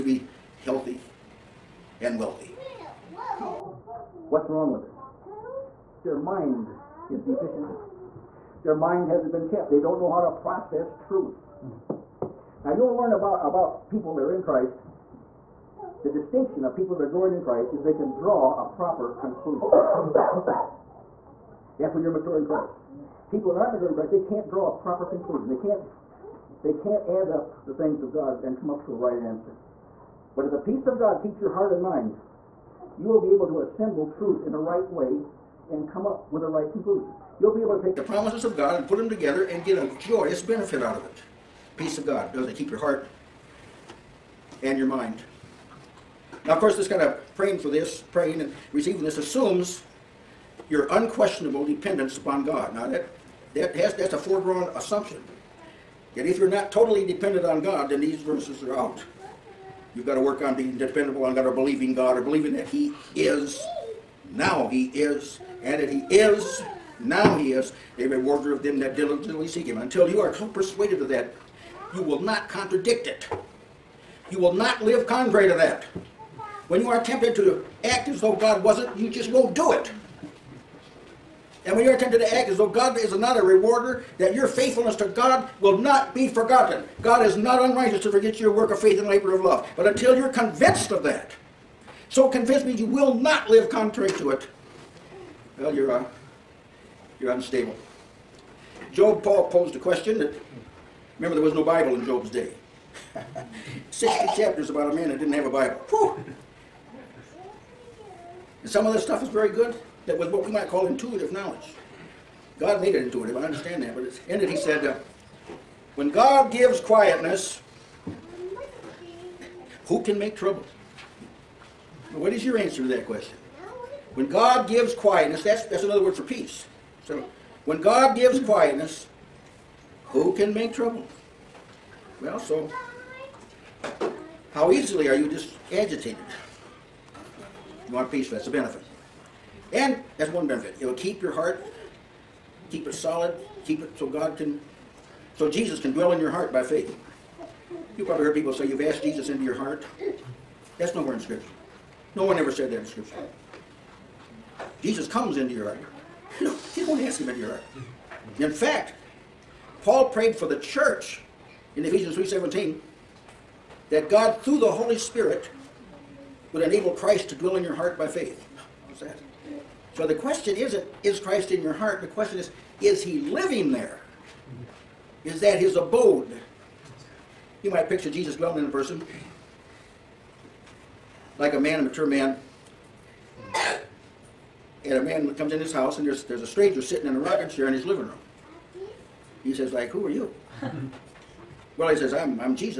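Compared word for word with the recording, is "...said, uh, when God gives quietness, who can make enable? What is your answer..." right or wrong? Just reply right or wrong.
wrong.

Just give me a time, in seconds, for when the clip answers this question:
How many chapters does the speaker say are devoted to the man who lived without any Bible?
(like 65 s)
103 s.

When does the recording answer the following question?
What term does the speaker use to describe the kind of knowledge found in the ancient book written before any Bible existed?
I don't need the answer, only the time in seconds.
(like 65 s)
110 s.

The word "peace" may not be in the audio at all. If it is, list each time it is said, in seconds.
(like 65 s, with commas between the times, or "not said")
30 s, 41 s, 126 s, 138 s.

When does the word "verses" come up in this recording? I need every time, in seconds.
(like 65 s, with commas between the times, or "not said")
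58 s.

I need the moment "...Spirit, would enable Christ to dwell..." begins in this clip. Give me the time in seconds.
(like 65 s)
164 s.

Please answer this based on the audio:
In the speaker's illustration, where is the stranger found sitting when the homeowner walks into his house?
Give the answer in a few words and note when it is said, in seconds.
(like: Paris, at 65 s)
a rocking chair, at 187 s.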